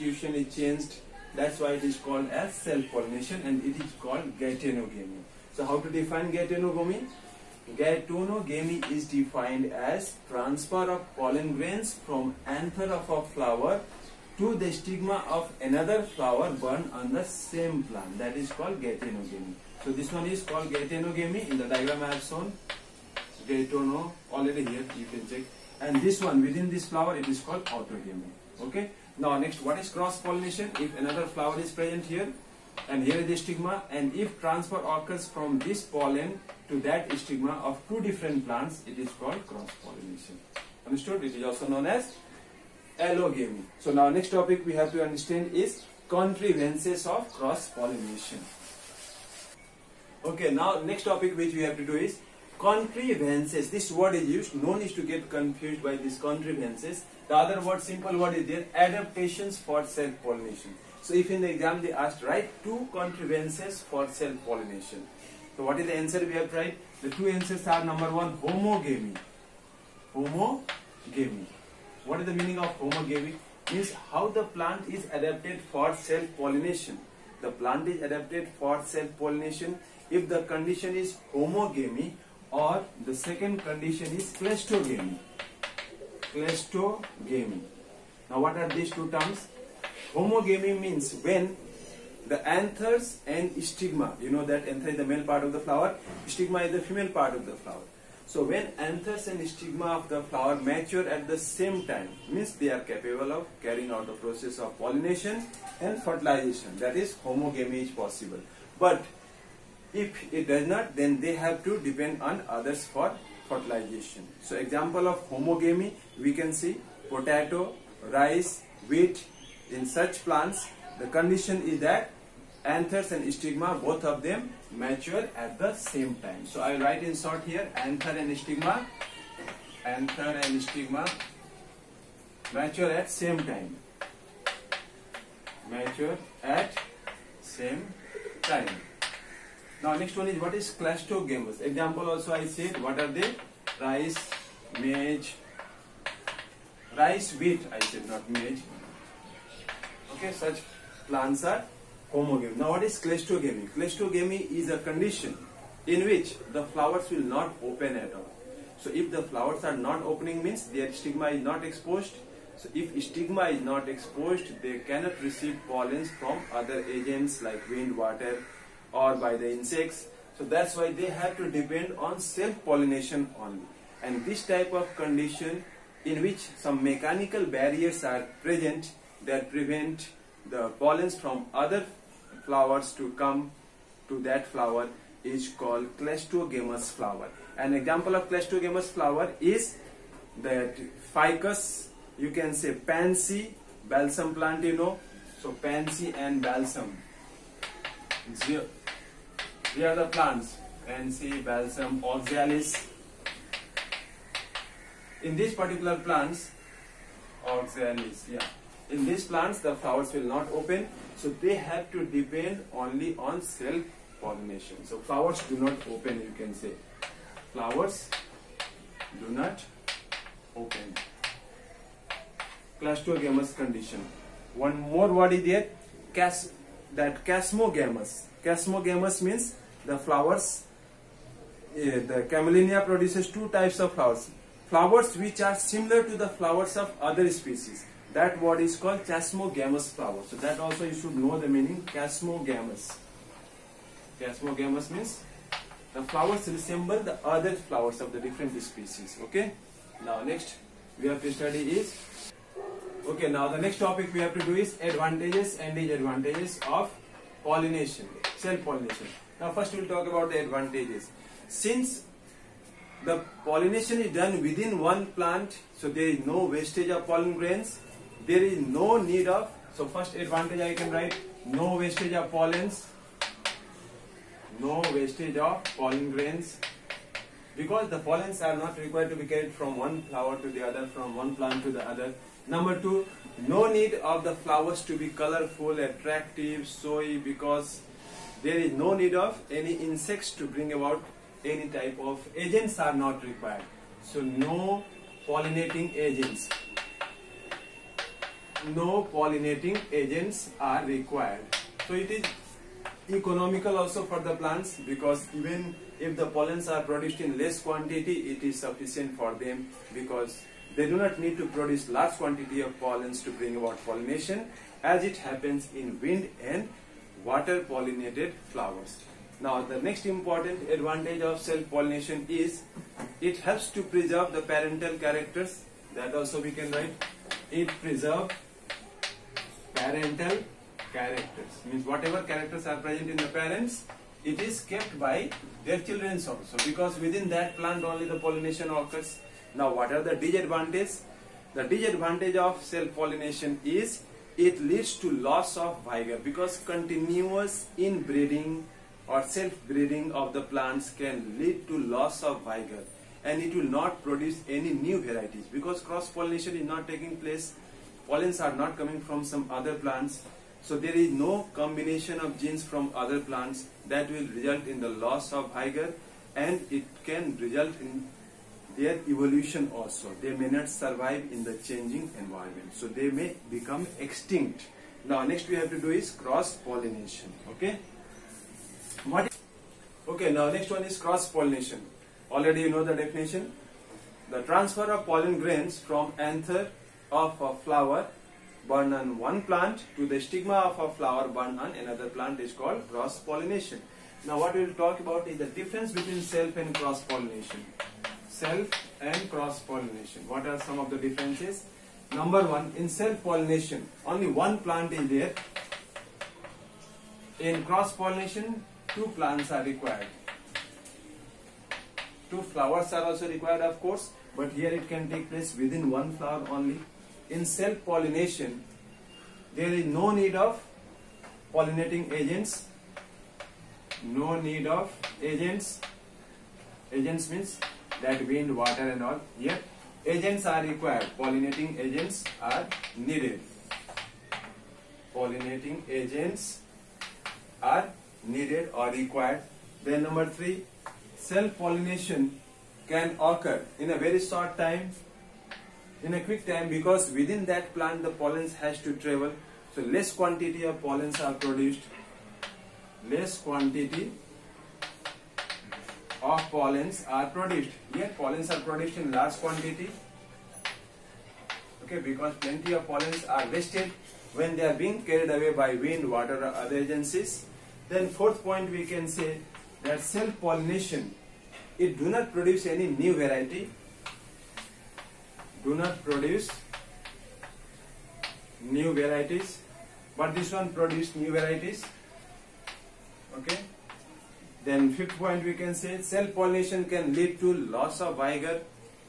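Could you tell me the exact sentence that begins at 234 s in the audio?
Flowers which are similar to the flowers of other species.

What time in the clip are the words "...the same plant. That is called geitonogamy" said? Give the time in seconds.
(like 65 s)
17 s.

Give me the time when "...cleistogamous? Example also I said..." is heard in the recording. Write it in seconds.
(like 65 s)
140 s.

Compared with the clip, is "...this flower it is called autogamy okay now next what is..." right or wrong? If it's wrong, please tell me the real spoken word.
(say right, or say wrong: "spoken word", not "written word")
right.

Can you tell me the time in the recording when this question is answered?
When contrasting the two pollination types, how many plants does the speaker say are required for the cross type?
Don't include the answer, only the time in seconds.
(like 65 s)
408 s.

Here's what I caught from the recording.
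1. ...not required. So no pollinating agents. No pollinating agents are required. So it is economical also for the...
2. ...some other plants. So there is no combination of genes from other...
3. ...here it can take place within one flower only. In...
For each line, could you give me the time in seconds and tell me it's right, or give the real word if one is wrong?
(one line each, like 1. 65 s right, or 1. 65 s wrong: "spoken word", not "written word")
1. 292 s right
2. 359 s right
3. 414 s right.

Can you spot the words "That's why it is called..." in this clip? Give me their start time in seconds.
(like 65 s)
1 s.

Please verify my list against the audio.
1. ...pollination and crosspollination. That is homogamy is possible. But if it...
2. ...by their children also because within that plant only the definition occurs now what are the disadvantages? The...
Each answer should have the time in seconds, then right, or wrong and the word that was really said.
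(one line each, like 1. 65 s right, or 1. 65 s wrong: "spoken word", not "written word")
1. 104 s wrong: "fertilization", not "crosspollination"
2. 334 s wrong: "pollination", not "definition".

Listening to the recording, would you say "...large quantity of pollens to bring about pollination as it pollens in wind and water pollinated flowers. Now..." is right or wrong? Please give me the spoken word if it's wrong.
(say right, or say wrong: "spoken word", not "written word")
wrong: "happens", not "pollens".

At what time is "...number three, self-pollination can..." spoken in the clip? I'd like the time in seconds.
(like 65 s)
440 s.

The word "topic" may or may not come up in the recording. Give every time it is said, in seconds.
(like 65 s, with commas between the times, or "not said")
44 s, 51 s, 253 s.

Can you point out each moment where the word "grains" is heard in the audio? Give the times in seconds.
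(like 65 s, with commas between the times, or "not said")
11 s, 267 s, 276 s, 385 s.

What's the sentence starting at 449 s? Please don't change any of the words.
So less quantity of pollens are produced.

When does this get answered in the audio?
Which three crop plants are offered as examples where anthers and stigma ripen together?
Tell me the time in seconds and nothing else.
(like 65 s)
117 s.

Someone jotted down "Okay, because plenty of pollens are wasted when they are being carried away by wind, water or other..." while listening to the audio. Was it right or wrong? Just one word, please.
right.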